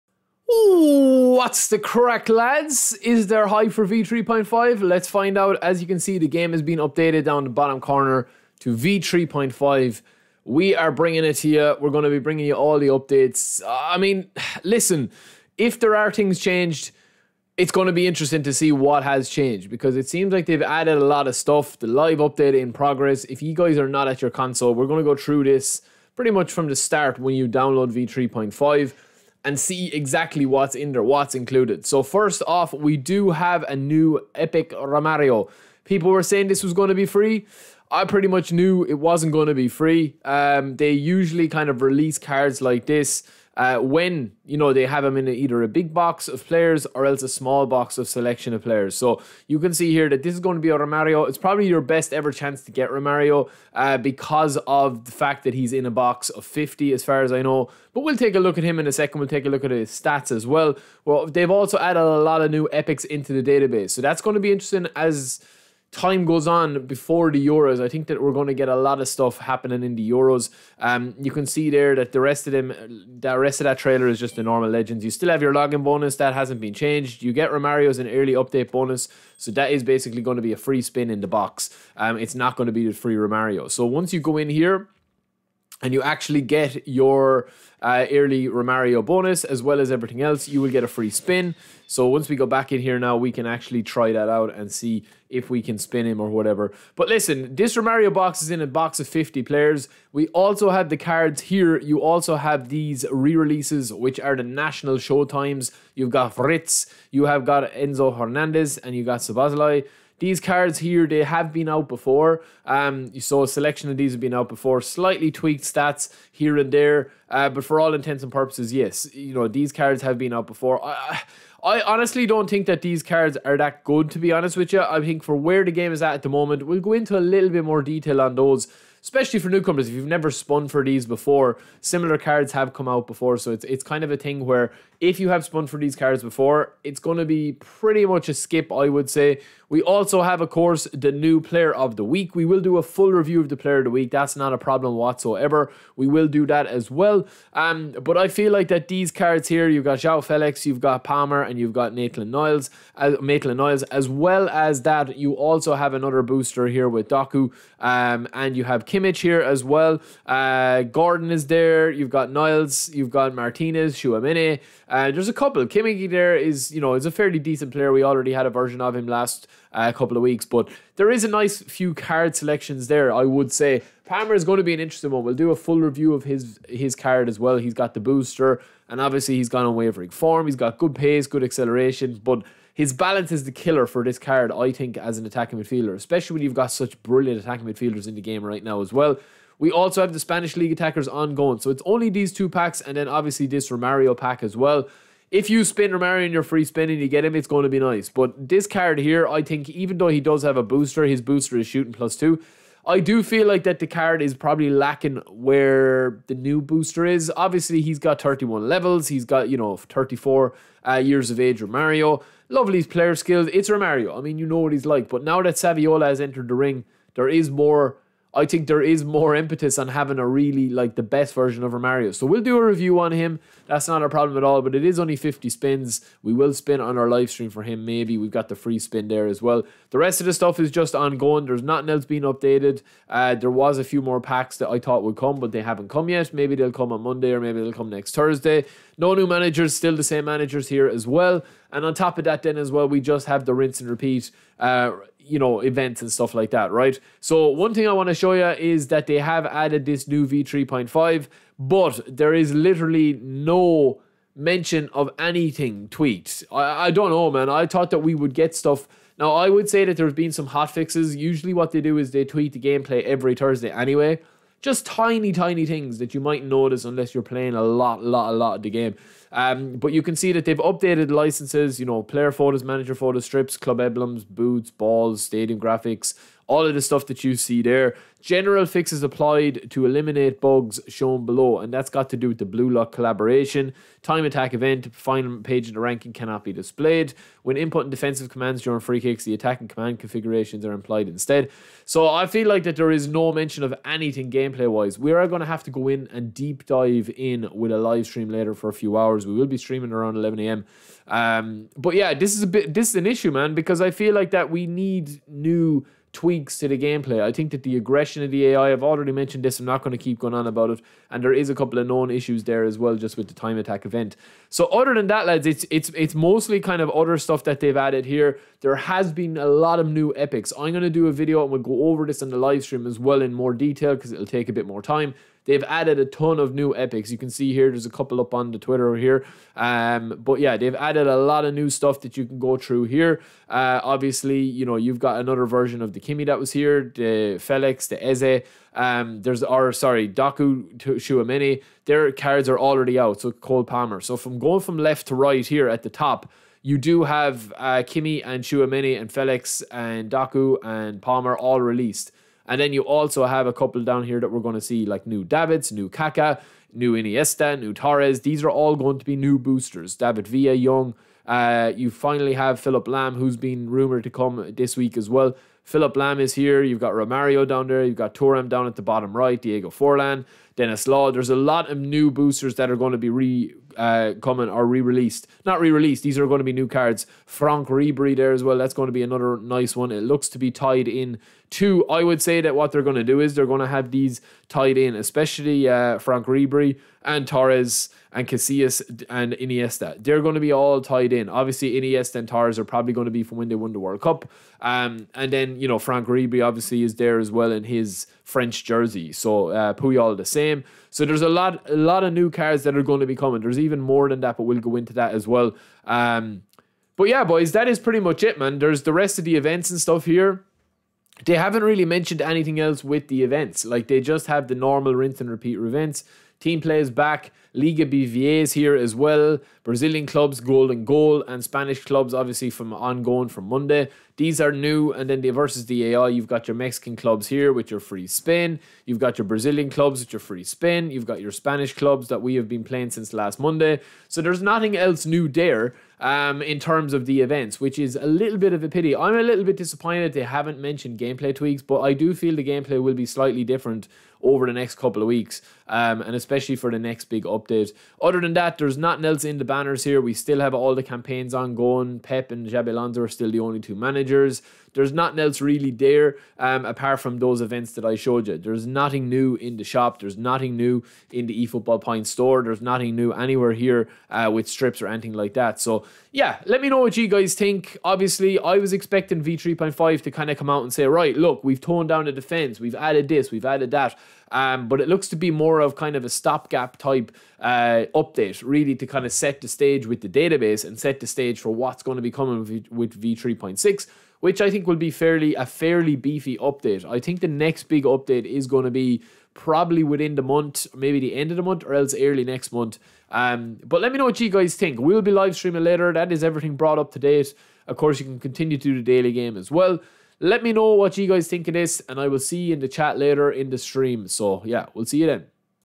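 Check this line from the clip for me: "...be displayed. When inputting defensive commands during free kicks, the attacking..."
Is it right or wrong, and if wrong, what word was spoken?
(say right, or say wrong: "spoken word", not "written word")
right.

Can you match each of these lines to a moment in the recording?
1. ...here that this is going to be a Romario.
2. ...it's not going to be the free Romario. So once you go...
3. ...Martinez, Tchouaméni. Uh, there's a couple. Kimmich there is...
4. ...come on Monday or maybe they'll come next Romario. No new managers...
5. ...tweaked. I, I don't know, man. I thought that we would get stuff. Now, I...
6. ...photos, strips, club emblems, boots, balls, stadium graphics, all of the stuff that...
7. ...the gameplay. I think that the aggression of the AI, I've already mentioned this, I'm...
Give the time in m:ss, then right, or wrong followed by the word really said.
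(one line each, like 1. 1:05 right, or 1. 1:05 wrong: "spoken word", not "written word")
1. 0:49 right
2. 1:22 right
3. 2:43 right
4. 3:56 wrong: "Thursday", not "Romario"
5. 4:15 right
6. 4:32 right
7. 5:06 right.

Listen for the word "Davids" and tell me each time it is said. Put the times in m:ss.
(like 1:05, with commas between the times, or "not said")
5:55, 5:59.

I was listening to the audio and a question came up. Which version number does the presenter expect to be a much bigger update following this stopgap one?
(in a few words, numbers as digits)
V3.6.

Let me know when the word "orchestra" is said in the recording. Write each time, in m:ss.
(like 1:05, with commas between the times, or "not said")
not said.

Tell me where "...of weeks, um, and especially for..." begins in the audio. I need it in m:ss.
7:25.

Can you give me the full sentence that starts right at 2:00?
I, I honestly don't think that these cards are that good, to be honest with you.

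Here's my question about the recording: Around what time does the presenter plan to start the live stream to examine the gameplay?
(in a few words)
11 a.m.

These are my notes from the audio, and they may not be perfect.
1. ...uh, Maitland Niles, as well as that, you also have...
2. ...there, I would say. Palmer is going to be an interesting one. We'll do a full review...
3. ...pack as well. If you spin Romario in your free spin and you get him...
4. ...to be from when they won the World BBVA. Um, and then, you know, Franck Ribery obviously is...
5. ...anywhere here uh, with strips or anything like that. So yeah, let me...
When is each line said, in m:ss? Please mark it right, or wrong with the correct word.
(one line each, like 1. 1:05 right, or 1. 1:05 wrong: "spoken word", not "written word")
1. 2:32 right
2. 2:52 right
3. 3:14 right
4. 6:33 wrong: "Cup", not "BBVA"
5. 7:43 right.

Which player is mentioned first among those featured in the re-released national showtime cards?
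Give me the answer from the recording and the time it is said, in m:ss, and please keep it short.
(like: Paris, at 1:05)
Fritz, at 1:46.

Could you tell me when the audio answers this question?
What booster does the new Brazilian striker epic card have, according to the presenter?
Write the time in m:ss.
3:21.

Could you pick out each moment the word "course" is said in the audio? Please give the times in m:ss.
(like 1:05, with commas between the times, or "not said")
2:20, 8:17.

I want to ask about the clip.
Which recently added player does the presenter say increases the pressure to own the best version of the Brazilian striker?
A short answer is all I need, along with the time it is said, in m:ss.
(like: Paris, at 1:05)
Saviola, at 3:35.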